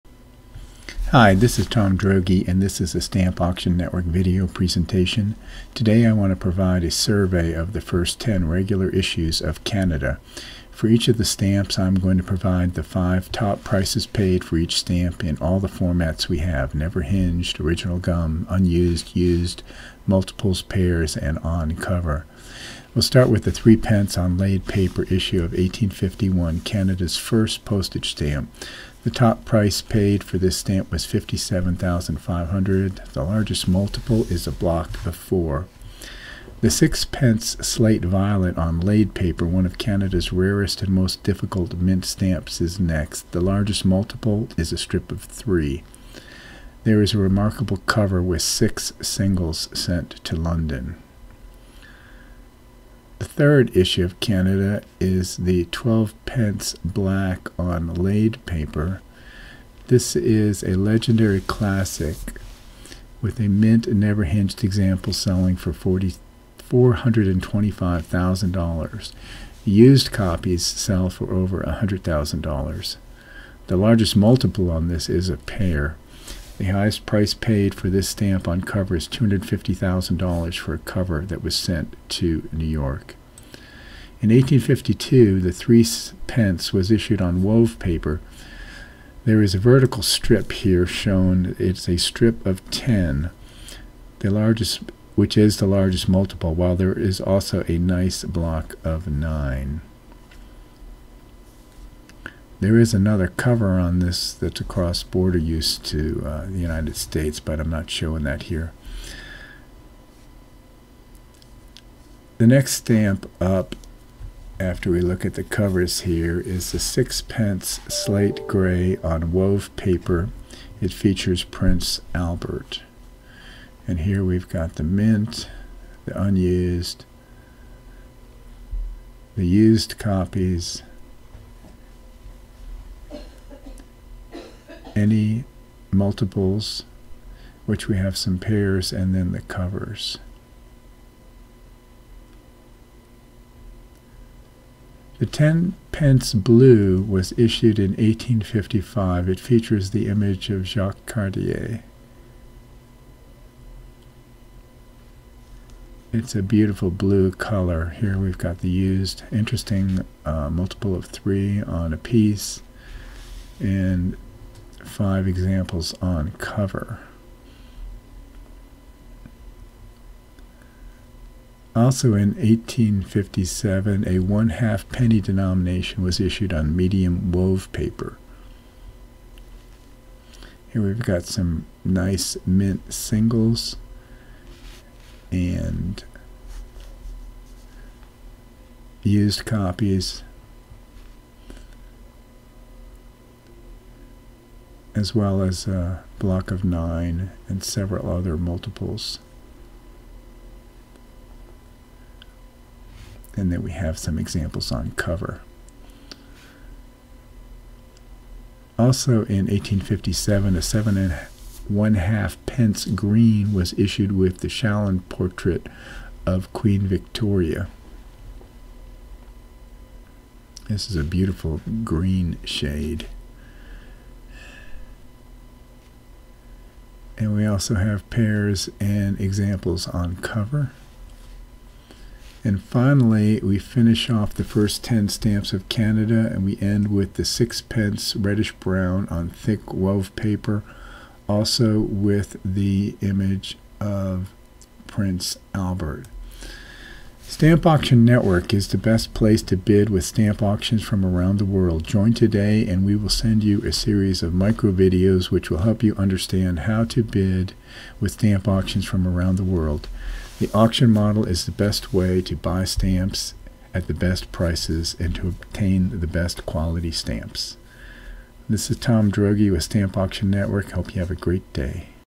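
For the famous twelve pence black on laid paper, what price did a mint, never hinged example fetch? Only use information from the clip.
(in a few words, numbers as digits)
$425,000.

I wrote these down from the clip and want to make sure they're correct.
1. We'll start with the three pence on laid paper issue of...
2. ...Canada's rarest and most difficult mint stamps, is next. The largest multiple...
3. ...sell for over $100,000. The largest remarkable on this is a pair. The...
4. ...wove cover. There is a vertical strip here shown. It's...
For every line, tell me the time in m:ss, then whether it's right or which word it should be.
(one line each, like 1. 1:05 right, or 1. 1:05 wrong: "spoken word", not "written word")
1. 0:22 right
2. 0:39 right
3. 1:10 wrong: "multiple", not "remarkable"
4. 1:27 wrong: "paper", not "cover".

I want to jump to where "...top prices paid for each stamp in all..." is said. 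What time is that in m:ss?
0:13.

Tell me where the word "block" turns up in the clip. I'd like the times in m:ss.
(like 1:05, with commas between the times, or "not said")
0:34, 1:38, 3:16.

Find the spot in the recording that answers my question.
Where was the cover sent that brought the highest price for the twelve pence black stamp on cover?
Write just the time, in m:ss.
1:22.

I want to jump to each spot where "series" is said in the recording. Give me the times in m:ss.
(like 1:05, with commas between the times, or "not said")
4:13.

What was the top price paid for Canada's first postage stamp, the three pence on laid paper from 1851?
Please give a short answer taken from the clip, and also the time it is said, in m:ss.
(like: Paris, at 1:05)
57500, at 0:31.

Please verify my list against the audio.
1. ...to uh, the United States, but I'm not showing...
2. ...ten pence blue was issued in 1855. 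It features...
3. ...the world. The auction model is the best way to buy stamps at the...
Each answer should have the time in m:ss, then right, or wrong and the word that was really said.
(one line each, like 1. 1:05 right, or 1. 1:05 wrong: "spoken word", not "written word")
1. 1:45 right
2. 2:25 right
3. 4:19 right.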